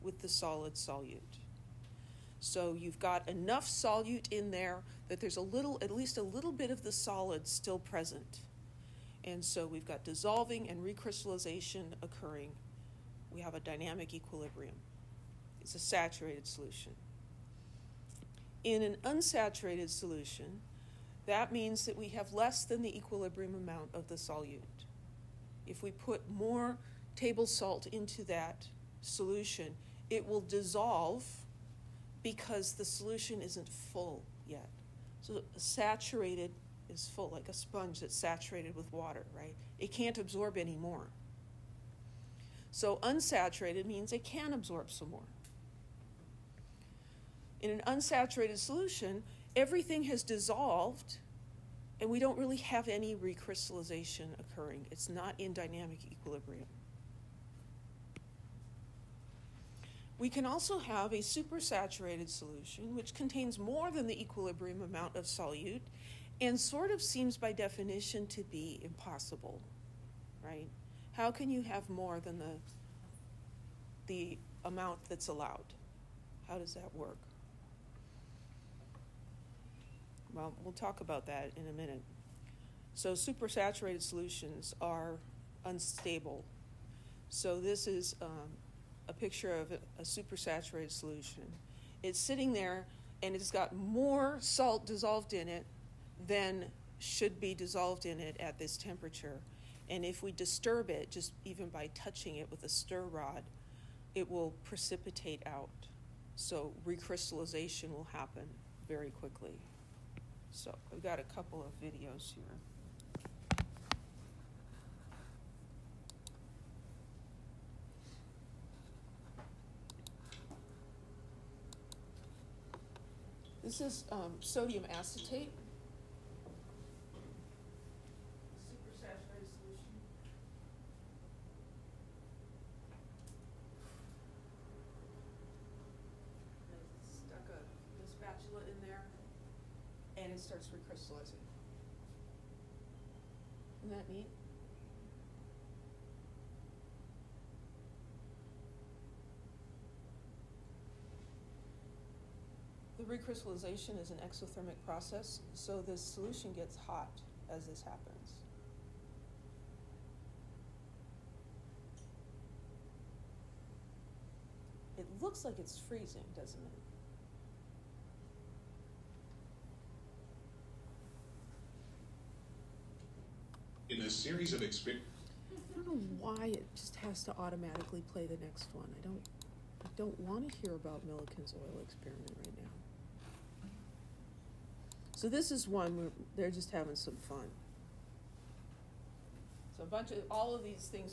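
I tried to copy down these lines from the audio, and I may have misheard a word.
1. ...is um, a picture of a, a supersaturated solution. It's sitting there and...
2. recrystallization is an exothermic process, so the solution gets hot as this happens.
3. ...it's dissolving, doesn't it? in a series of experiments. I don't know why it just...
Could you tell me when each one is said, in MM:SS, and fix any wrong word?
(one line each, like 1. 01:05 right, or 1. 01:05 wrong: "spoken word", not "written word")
1. 01:27 right
2. 02:33 right
3. 02:45 wrong: "freezing", not "dissolving".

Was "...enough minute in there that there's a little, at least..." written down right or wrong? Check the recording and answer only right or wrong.
wrong.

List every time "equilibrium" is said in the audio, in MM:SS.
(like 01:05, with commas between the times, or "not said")
00:14, 00:22, 00:56, 01:04.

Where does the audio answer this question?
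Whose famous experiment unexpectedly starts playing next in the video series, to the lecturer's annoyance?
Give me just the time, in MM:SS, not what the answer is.
03:01.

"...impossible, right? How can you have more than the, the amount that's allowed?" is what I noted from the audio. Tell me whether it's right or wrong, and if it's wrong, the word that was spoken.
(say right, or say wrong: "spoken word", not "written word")
right.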